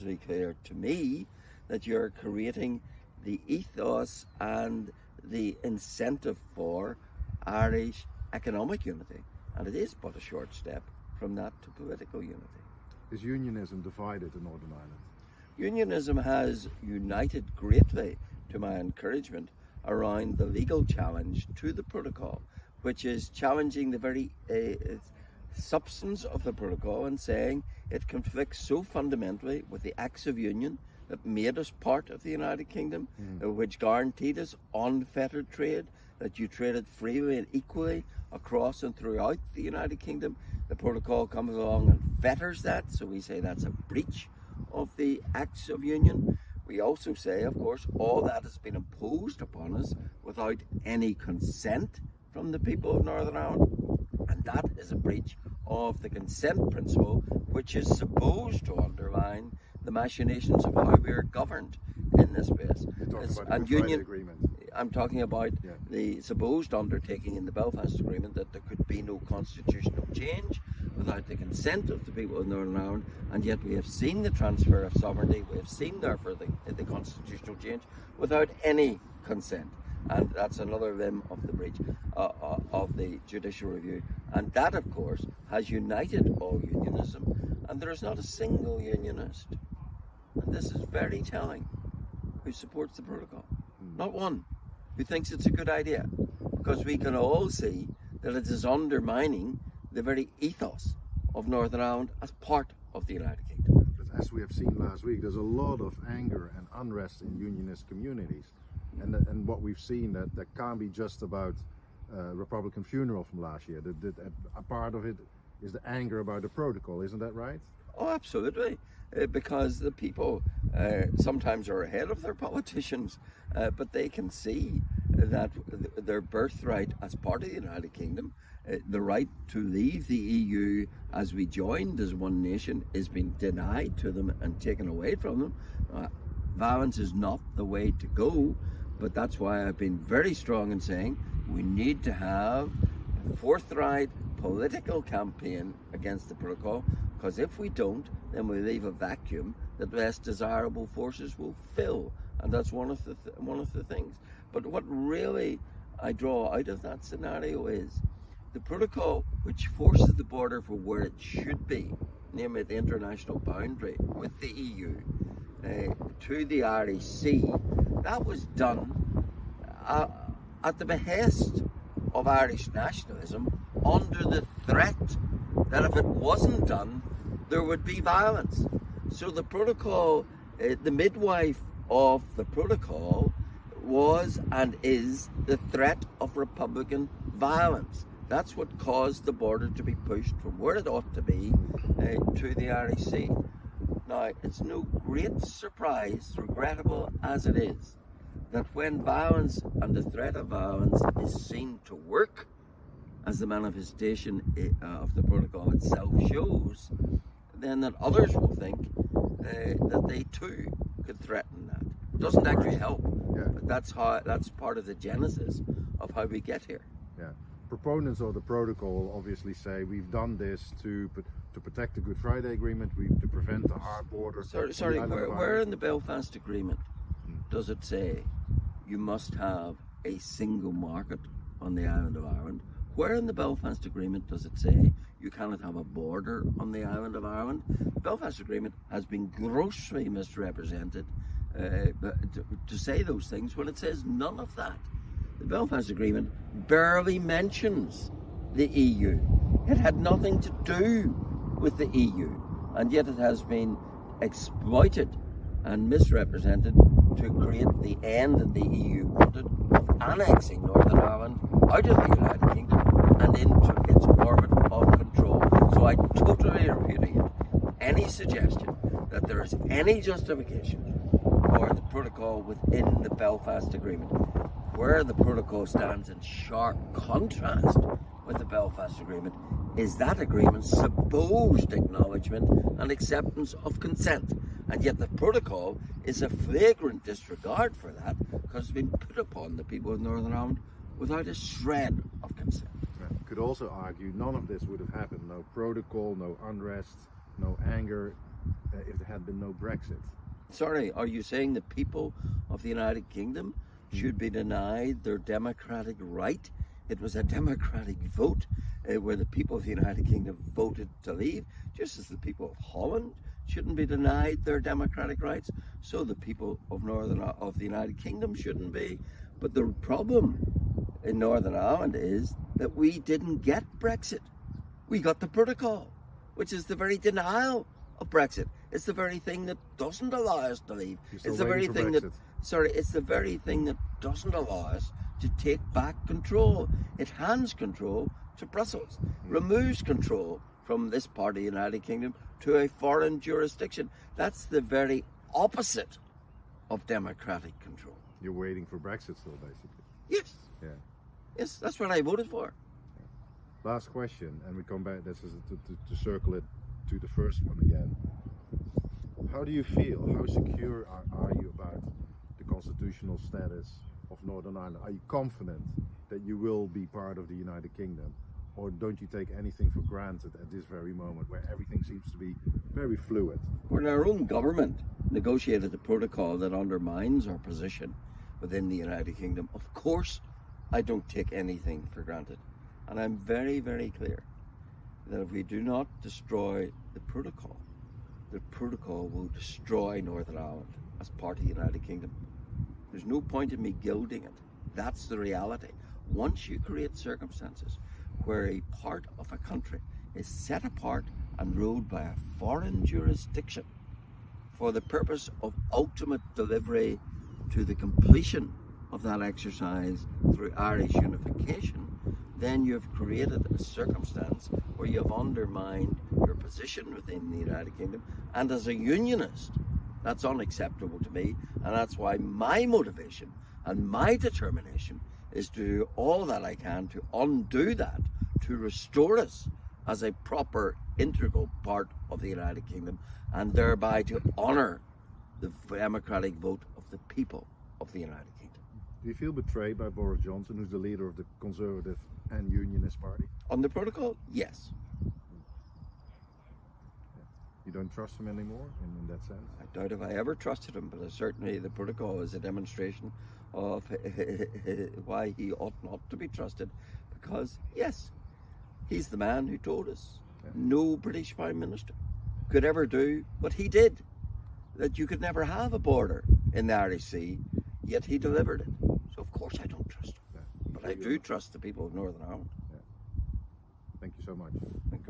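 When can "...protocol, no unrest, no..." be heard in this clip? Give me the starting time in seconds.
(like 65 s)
295 s.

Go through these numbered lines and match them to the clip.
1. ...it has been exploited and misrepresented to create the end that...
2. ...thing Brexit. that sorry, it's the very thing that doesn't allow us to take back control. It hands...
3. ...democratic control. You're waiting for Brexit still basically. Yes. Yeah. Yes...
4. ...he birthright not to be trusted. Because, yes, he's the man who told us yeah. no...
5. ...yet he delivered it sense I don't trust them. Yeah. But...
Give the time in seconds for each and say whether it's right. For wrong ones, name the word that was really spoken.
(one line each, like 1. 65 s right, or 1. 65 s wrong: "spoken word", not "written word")
1. 253 s right
2. 331 s right
3. 346 s right
4. 455 s wrong: "ought", not "birthright"
5. 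467 s wrong: "course", not "sense".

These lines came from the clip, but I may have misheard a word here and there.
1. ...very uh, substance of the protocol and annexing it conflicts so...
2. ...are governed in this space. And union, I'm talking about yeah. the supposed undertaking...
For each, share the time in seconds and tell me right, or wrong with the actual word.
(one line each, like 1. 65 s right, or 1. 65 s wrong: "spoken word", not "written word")
1. 23 s wrong: "saying", not "annexing"
2. 61 s right.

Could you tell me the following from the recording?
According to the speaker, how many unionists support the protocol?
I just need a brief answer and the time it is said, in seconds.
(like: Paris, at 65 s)
Not one, at 93 s.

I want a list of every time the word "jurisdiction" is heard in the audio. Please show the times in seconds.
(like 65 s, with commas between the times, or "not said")
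343 s, 402 s.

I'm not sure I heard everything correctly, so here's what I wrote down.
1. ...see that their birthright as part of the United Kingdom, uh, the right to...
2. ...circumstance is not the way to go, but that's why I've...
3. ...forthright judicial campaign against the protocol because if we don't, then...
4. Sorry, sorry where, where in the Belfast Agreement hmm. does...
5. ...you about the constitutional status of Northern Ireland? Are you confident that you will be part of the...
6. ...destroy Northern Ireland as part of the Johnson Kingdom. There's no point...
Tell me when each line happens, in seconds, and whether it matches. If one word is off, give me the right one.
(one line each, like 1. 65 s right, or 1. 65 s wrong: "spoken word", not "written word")
1. 124 s right
2. 136 s wrong: "violence", not "circumstance"
3. 143 s wrong: "political", not "judicial"
4. 224 s right
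5. 361 s right
6. 389 s wrong: "United", not "Johnson".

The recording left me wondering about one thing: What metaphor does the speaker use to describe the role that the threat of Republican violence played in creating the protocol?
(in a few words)
the midwife.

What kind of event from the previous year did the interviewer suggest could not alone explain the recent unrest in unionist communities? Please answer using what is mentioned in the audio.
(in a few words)
Republican funeral.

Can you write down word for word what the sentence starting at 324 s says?
We got the protocol, which is the very denial of Brexit.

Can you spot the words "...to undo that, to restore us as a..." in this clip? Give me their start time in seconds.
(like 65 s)
426 s.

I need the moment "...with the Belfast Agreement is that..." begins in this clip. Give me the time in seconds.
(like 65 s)
278 s.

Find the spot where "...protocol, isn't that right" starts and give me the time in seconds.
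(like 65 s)
116 s.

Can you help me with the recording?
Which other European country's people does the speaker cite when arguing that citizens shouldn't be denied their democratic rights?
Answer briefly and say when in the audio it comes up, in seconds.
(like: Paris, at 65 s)
Holland, at 312 s.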